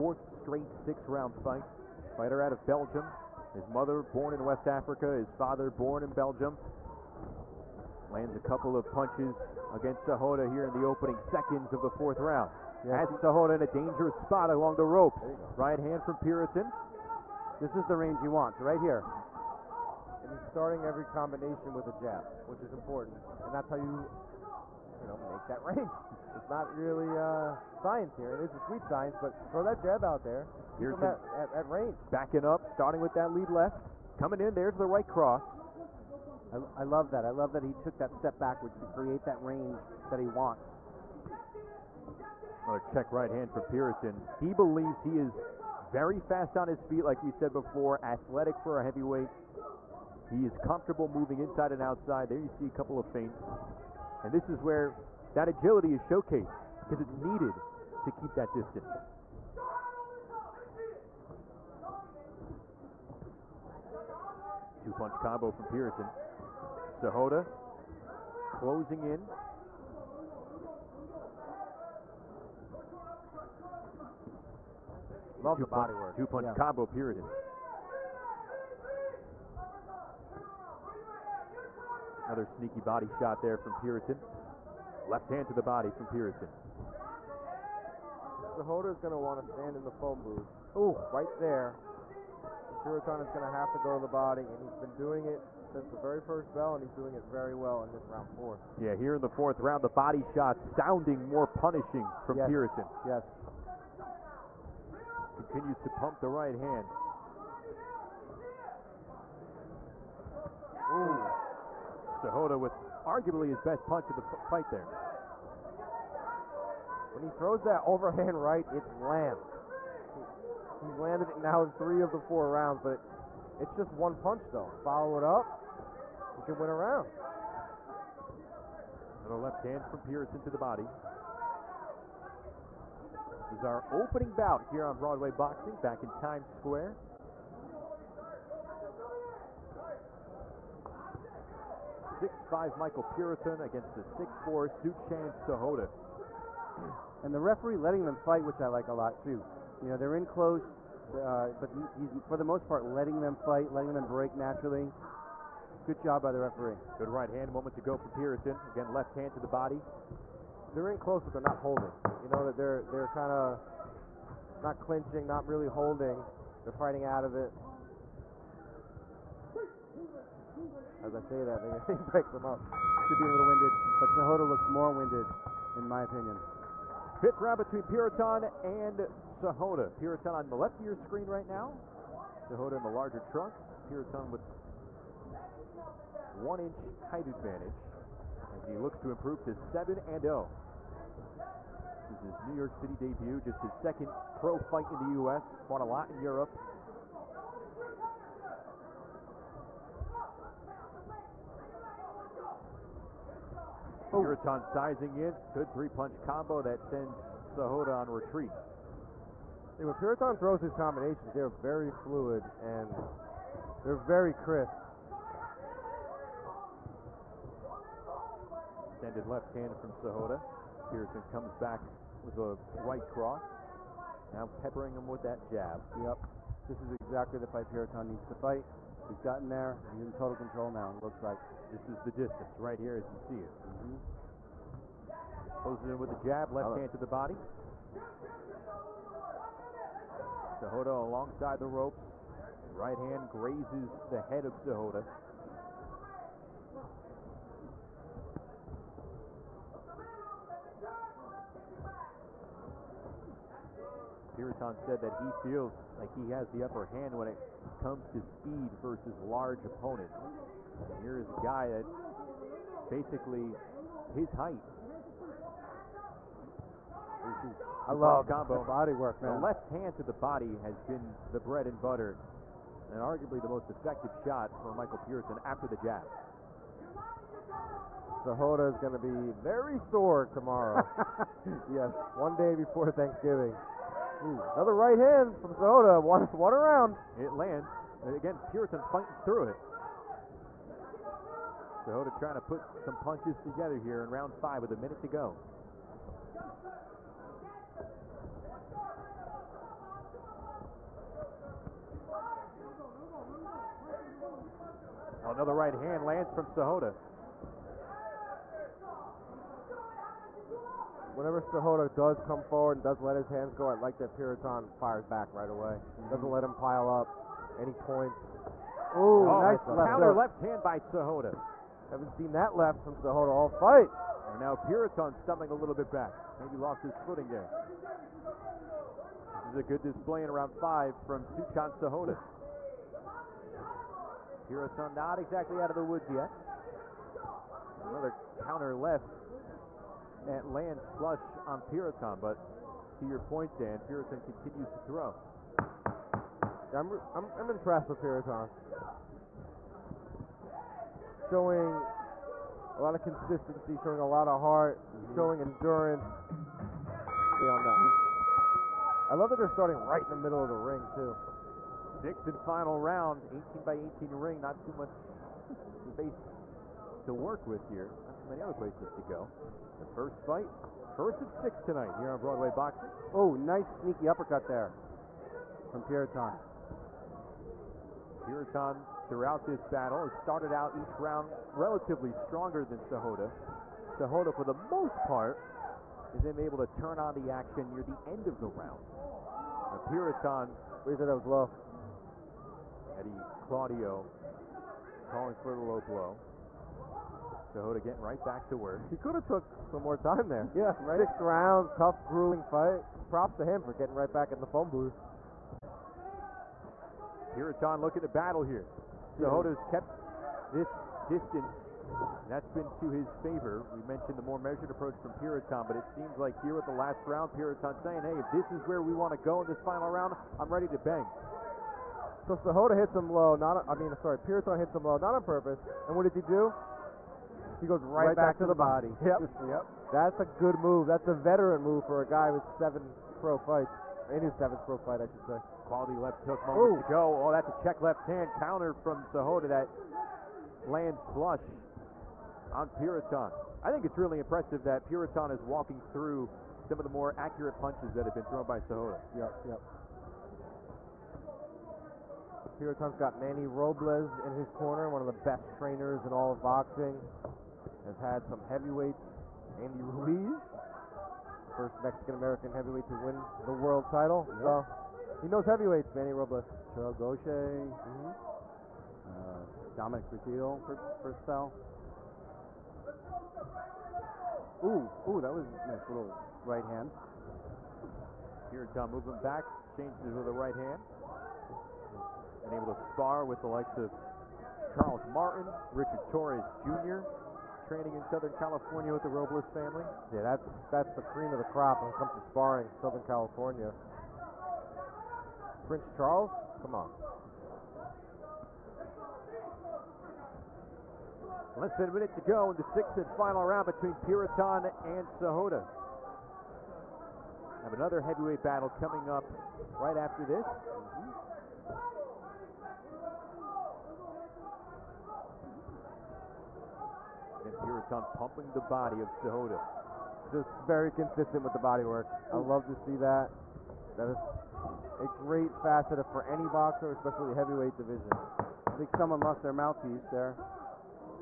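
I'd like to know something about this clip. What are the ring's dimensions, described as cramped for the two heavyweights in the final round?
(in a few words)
18 by 18.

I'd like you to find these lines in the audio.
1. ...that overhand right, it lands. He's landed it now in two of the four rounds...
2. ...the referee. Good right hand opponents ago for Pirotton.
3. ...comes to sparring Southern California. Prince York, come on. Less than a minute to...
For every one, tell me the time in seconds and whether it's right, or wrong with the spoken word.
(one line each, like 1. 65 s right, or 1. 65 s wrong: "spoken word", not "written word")
1. 117 s wrong: "three", not "two"
2. 156 s wrong: "moments", not "opponents"
3. 491 s wrong: "Charles", not "York".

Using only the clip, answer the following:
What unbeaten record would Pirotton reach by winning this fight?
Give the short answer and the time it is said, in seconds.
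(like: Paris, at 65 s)
7-0, at 189 s.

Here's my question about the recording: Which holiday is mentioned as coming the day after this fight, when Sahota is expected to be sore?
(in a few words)
Thanksgiving.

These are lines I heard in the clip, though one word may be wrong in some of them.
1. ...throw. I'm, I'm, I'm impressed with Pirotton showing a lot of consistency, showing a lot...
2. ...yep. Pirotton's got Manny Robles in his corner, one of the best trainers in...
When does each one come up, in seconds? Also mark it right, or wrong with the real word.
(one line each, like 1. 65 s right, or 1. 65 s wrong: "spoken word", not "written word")
1. 344 s right
2. 449 s right.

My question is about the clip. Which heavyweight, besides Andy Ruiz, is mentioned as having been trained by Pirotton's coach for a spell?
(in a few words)
Dominic Breazeale.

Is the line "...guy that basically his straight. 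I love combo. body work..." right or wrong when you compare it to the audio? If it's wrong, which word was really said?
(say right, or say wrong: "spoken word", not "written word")
wrong: "height", not "straight".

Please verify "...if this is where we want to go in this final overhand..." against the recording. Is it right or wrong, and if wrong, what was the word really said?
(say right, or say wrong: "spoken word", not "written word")
wrong: "round", not "overhand".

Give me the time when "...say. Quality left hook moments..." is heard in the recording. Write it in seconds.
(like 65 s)
435 s.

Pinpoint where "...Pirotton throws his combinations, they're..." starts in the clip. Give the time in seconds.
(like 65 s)
209 s.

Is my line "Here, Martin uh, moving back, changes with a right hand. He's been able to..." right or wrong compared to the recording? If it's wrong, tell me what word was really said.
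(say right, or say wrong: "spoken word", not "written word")
wrong: "Tom", not "Martin".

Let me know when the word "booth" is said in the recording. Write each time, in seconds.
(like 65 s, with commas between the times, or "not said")
90 s, 404 s.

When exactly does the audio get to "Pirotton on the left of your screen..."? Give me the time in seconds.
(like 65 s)
180 s.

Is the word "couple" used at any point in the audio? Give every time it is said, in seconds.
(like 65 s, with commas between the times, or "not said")
8 s, 52 s.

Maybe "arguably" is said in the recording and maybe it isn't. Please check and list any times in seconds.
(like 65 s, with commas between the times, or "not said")
113 s, 273 s.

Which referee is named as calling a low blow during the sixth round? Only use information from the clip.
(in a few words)
Eddie Claudio.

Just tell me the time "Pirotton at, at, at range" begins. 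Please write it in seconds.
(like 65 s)
30 s.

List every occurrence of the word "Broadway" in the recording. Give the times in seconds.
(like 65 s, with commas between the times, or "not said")
134 s, 372 s.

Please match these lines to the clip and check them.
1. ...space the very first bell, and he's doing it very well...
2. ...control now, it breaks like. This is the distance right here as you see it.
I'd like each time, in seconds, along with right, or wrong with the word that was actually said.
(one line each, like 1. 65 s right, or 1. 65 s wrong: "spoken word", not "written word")
1. 95 s wrong: "since", not "space"
2. 230 s wrong: "looks", not "breaks".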